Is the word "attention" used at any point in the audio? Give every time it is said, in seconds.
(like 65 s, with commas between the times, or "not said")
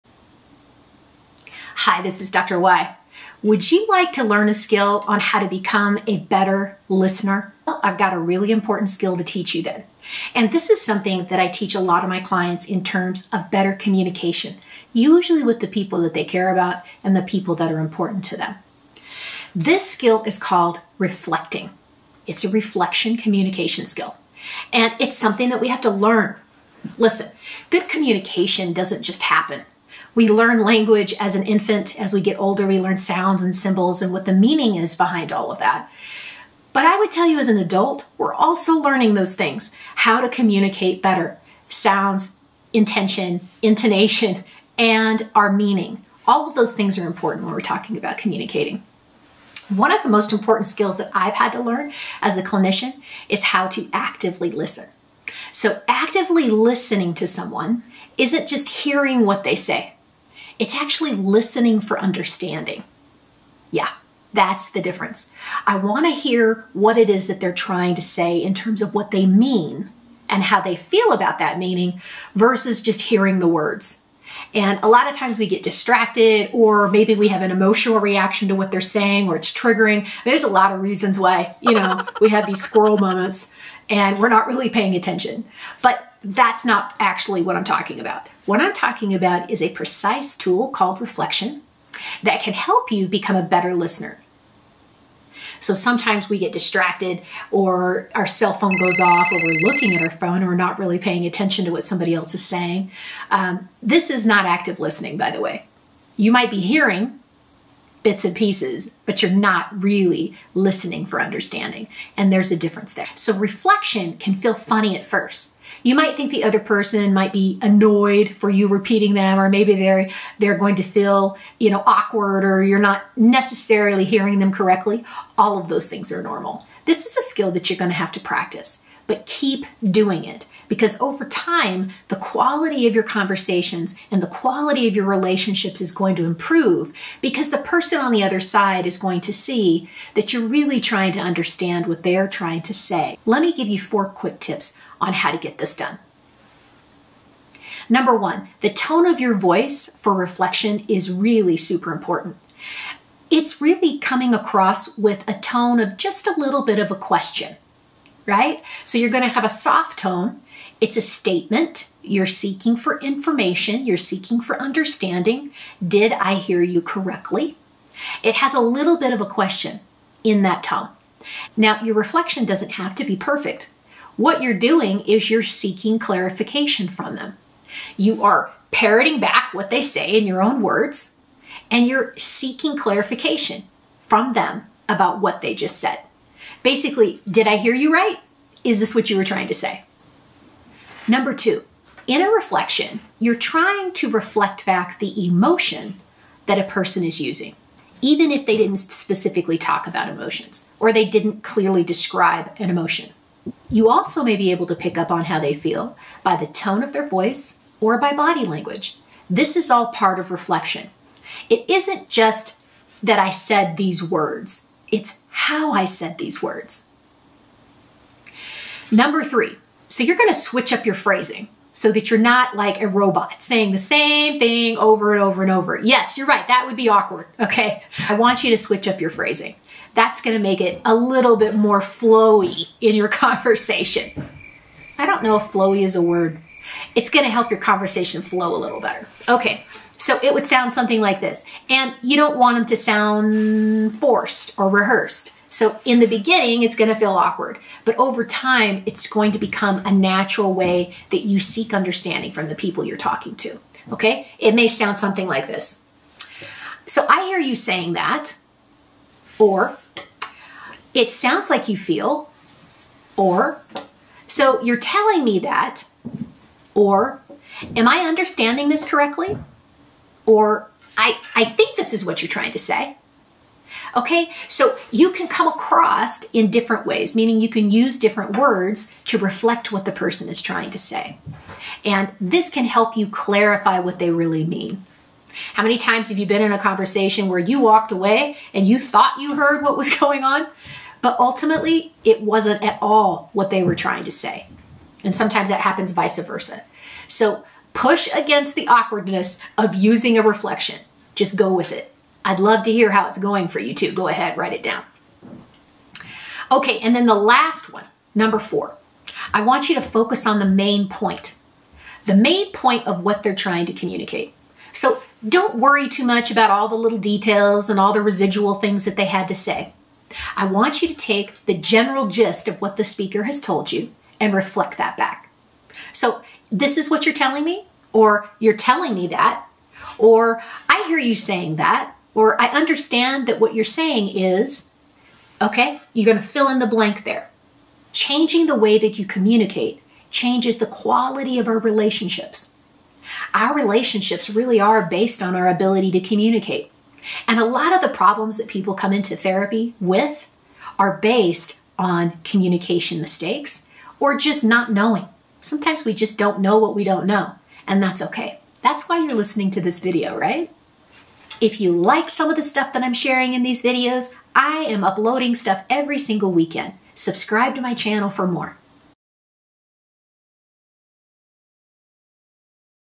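84 s, 101 s.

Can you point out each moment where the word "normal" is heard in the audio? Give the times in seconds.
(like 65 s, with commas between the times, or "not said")
126 s.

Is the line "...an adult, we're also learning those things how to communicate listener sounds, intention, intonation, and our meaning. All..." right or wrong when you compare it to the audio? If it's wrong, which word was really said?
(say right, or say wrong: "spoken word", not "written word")
wrong: "better", not "listener".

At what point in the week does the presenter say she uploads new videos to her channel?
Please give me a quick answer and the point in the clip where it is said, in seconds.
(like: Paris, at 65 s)
weekend, at 366 s.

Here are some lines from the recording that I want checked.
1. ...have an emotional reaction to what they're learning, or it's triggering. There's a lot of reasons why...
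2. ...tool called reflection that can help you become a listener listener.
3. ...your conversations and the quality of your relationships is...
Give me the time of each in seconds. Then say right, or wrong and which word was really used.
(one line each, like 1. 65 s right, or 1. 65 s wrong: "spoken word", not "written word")
1. 77 s wrong: "saying", not "learning"
2. 90 s wrong: "better", not "listener"
3. 132 s right.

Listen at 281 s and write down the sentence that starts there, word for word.
And this can help you clarify what they really mean.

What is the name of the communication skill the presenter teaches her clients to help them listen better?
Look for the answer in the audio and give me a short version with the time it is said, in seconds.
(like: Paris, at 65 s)
reflecting, at 20 s.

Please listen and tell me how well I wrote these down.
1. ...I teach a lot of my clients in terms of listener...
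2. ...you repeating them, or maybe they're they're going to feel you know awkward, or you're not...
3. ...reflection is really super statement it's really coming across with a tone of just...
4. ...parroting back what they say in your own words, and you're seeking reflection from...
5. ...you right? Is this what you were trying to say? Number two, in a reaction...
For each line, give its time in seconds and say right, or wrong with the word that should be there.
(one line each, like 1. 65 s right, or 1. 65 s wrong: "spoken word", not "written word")
1. 11 s wrong: "better", not "listener"
2. 118 s right
3. 150 s wrong: "important", not "statement"
4. 178 s wrong: "clarification", not "reflection"
5. 187 s wrong: "reflection", not "reaction".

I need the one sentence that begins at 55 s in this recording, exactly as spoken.
So, actively listening to someone isn't just hearing what they say, it's actually listening for understanding.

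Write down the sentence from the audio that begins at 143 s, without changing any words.
Let me give you four quick tips on how to get this done.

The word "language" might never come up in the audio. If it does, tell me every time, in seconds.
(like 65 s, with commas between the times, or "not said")
30 s, 208 s.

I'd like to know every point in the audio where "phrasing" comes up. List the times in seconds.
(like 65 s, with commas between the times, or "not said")
220 s, 229 s.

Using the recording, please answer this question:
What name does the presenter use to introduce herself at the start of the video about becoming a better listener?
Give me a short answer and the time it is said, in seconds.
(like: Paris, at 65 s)
Dr. Y, at 2 s.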